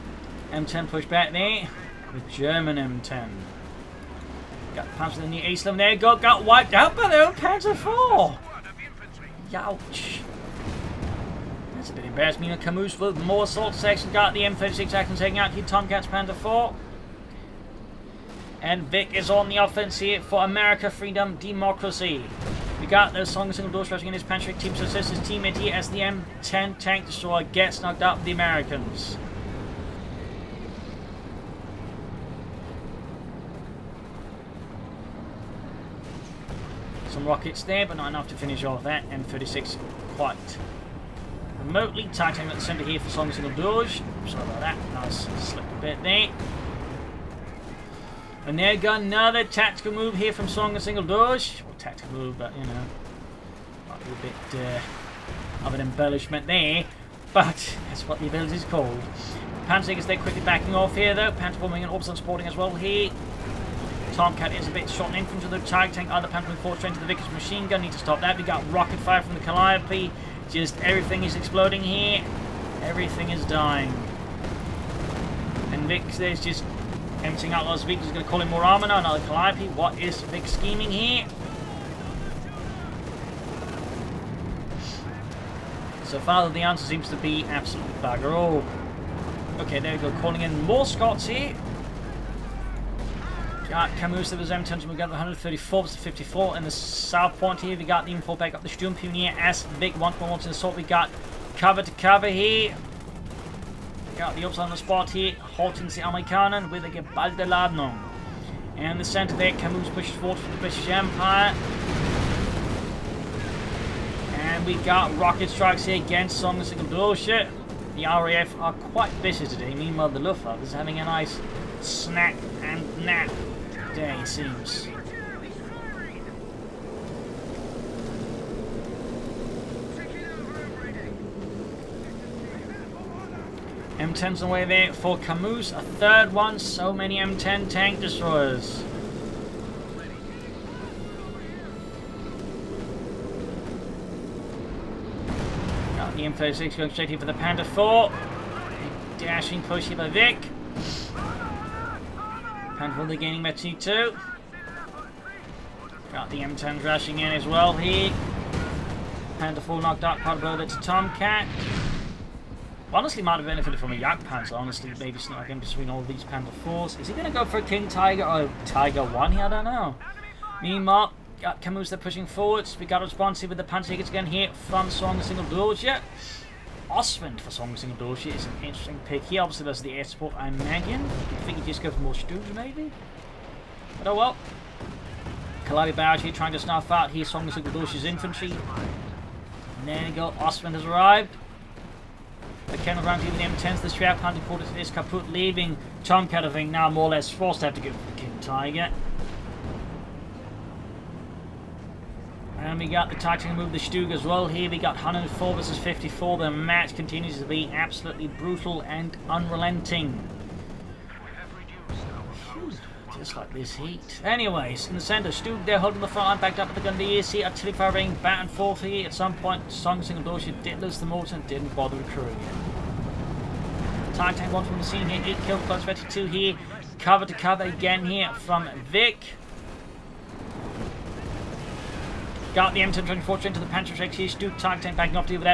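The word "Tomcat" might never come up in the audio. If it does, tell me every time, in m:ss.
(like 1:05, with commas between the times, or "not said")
0:15, 1:04, 2:40.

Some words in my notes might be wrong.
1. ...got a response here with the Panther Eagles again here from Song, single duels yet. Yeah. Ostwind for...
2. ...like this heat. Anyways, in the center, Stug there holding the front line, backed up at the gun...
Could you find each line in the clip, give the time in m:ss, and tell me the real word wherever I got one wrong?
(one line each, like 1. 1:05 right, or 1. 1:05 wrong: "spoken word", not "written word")
1. 2:52 right
2. 3:33 right.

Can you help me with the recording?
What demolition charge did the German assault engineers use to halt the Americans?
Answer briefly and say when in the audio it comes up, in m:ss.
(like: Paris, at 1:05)
geballte Ladung, at 1:46.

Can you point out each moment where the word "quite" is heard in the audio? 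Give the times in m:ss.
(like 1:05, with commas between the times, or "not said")
0:40, 1:58, 2:40.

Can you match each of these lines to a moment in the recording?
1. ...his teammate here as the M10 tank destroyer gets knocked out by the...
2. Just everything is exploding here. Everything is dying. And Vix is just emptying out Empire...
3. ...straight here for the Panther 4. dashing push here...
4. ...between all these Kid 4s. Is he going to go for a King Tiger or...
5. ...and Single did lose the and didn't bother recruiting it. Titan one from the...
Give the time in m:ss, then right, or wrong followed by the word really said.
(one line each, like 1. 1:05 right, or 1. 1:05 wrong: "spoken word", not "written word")
1. 0:25 right
2. 1:10 wrong: "Las", not "Empire"
3. 2:26 right
4. 2:45 wrong: "Panther", not "Kid"
5. 3:40 wrong: "Bullshit", not "Single".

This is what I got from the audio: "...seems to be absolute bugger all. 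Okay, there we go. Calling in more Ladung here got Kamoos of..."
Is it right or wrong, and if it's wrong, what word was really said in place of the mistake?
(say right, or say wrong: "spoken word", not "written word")
wrong: "Scots", not "Ladung".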